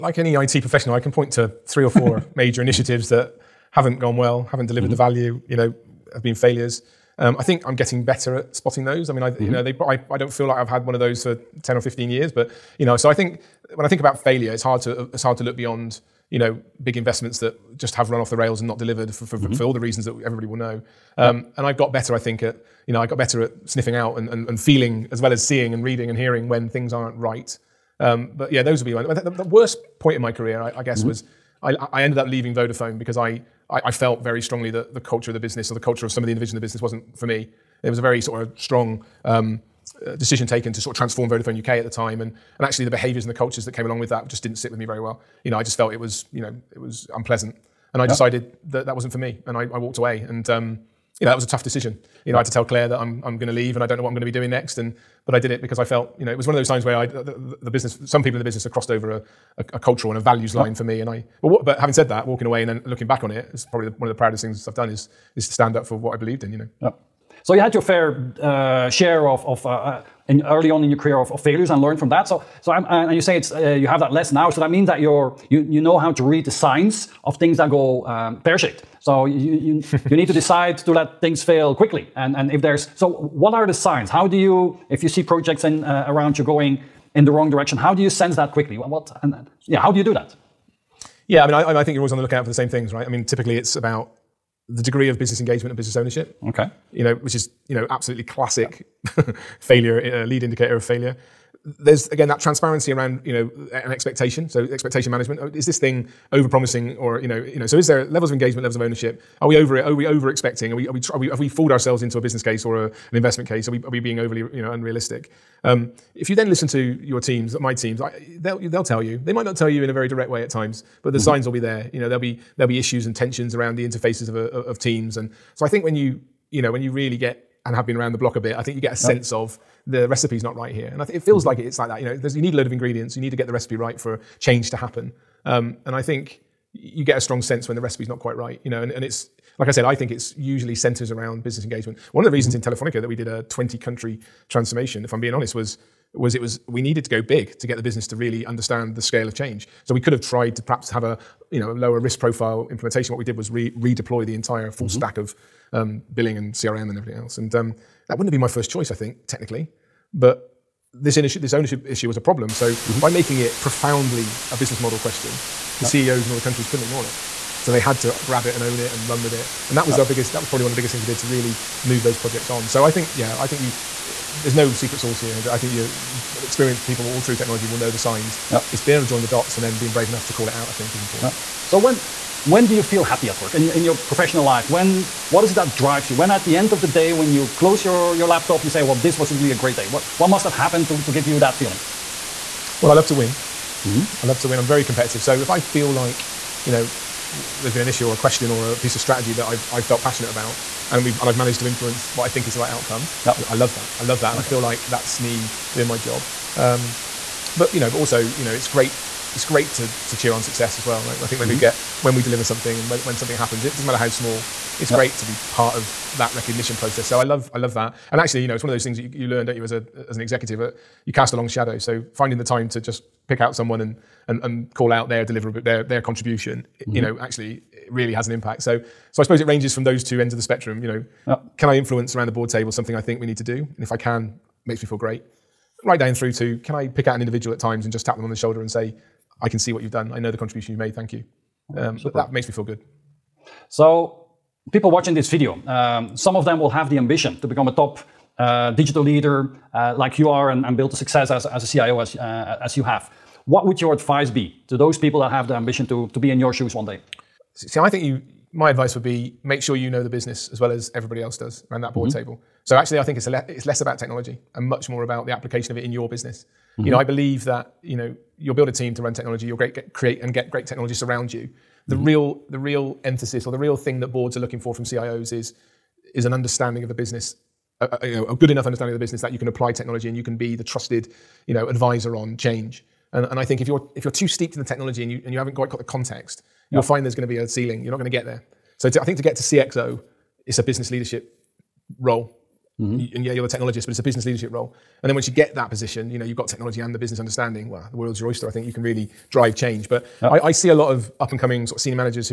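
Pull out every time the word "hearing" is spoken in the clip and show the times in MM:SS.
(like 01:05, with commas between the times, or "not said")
00:26.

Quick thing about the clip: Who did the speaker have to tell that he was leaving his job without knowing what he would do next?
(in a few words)
Claire.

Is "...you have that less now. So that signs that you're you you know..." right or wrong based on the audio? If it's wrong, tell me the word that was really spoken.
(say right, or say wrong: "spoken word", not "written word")
wrong: "means", not "signs".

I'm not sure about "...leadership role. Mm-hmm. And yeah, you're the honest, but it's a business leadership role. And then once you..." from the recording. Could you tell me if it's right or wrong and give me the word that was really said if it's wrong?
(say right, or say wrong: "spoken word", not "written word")
wrong: "technologist", not "honest".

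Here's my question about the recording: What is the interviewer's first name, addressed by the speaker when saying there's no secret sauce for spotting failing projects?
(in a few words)
Hendrik.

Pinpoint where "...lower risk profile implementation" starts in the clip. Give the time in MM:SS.
02:31.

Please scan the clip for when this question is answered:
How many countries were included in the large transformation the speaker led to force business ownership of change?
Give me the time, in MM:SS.
02:23.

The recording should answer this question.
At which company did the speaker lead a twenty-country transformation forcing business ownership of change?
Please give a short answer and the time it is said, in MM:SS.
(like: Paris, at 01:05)
Telefonica, at 02:22.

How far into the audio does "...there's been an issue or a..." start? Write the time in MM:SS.
03:17.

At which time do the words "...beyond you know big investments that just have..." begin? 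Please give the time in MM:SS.
00:15.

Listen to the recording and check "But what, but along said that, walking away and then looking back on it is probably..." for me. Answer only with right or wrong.
wrong.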